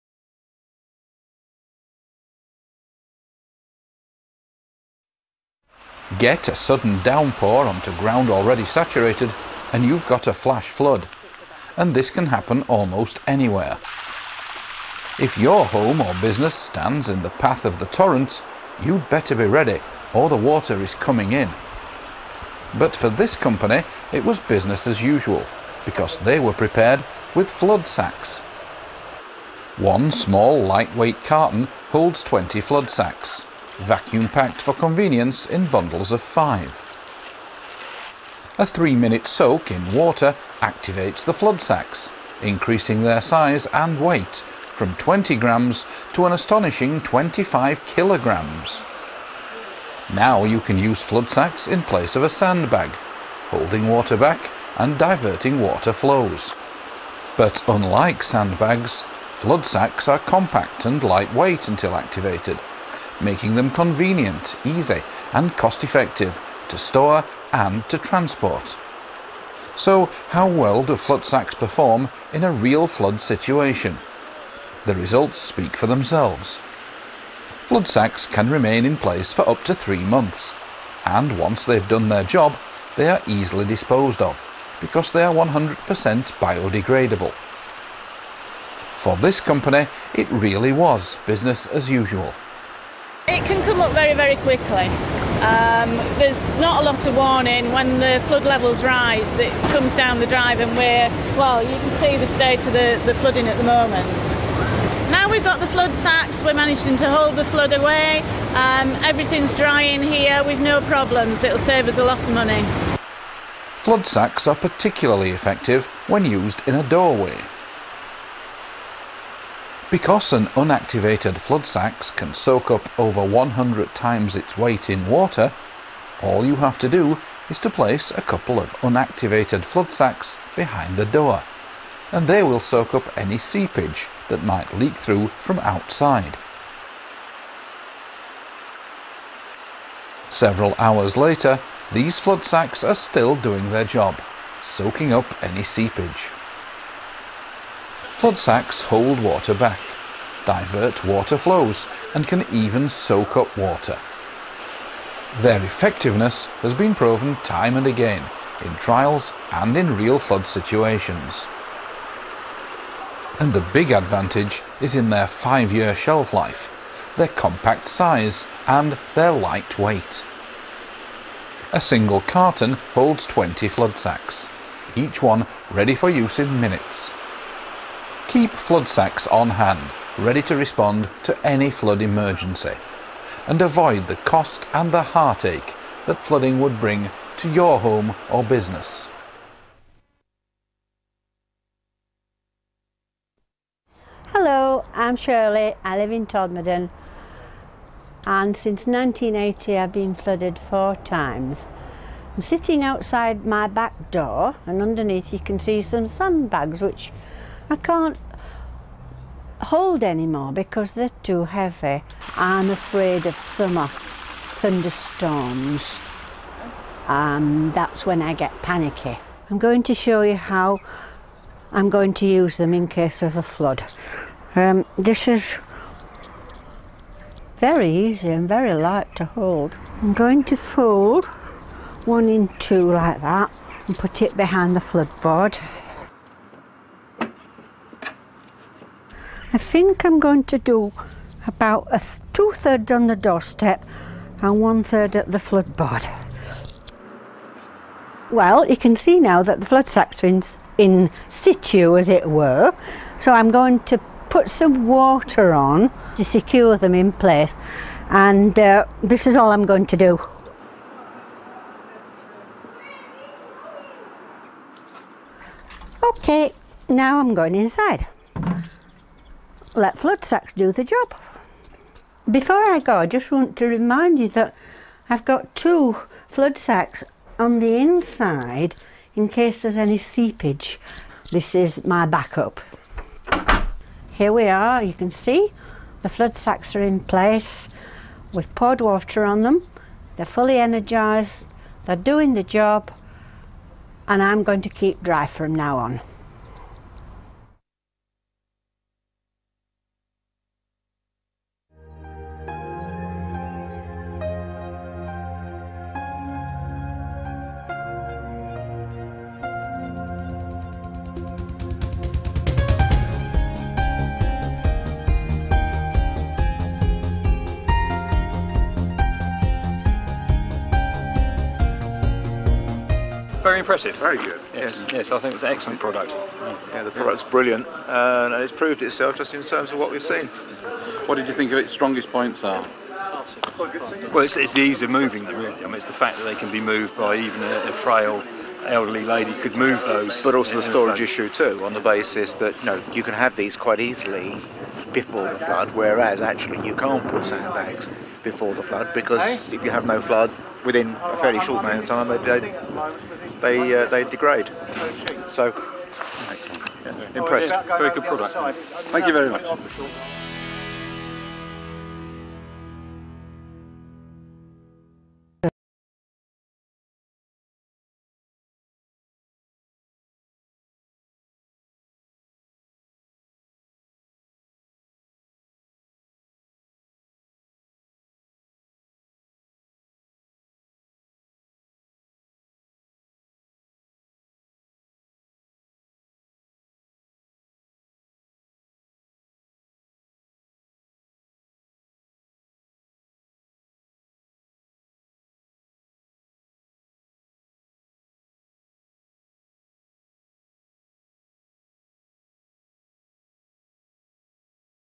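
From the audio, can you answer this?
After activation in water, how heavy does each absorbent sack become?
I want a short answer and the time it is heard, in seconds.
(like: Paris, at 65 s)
25 kilograms, at 47 s.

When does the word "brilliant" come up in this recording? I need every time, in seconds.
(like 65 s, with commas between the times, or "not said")
327 s.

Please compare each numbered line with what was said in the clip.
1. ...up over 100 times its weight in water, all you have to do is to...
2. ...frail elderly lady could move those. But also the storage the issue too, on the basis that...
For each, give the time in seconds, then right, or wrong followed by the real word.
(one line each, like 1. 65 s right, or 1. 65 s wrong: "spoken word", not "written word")
1. 122 s right
2. 337 s right.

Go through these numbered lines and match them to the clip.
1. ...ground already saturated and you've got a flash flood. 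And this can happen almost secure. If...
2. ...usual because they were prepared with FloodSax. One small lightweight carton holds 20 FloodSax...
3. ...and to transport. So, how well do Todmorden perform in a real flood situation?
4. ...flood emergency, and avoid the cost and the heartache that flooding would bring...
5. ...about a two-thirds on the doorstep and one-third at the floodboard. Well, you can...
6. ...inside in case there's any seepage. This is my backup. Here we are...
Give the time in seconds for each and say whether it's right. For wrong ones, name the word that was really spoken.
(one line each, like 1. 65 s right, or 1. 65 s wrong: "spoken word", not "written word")
1. 7 s wrong: "anywhere", not "secure"
2. 25 s right
3. 67 s wrong: "FloodSax", not "Todmorden"
4. 181 s right
5. 241 s right
6. 277 s right.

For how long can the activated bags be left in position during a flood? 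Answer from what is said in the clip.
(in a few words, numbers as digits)
up to 3 months.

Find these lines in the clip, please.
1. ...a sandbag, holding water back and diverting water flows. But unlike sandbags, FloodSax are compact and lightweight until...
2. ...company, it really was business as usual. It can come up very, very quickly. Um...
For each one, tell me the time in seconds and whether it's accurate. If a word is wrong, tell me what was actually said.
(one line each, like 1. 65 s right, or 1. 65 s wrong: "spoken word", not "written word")
1. 52 s right
2. 89 s right.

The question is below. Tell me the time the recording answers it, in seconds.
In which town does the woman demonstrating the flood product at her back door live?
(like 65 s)
196 s.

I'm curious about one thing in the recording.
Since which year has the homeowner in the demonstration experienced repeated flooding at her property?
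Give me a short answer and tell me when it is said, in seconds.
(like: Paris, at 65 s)
1980, at 198 s.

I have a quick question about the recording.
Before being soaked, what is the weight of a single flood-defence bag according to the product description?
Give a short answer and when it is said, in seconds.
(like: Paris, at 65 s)
20 grams, at 44 s.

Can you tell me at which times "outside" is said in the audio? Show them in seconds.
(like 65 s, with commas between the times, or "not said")
135 s, 202 s.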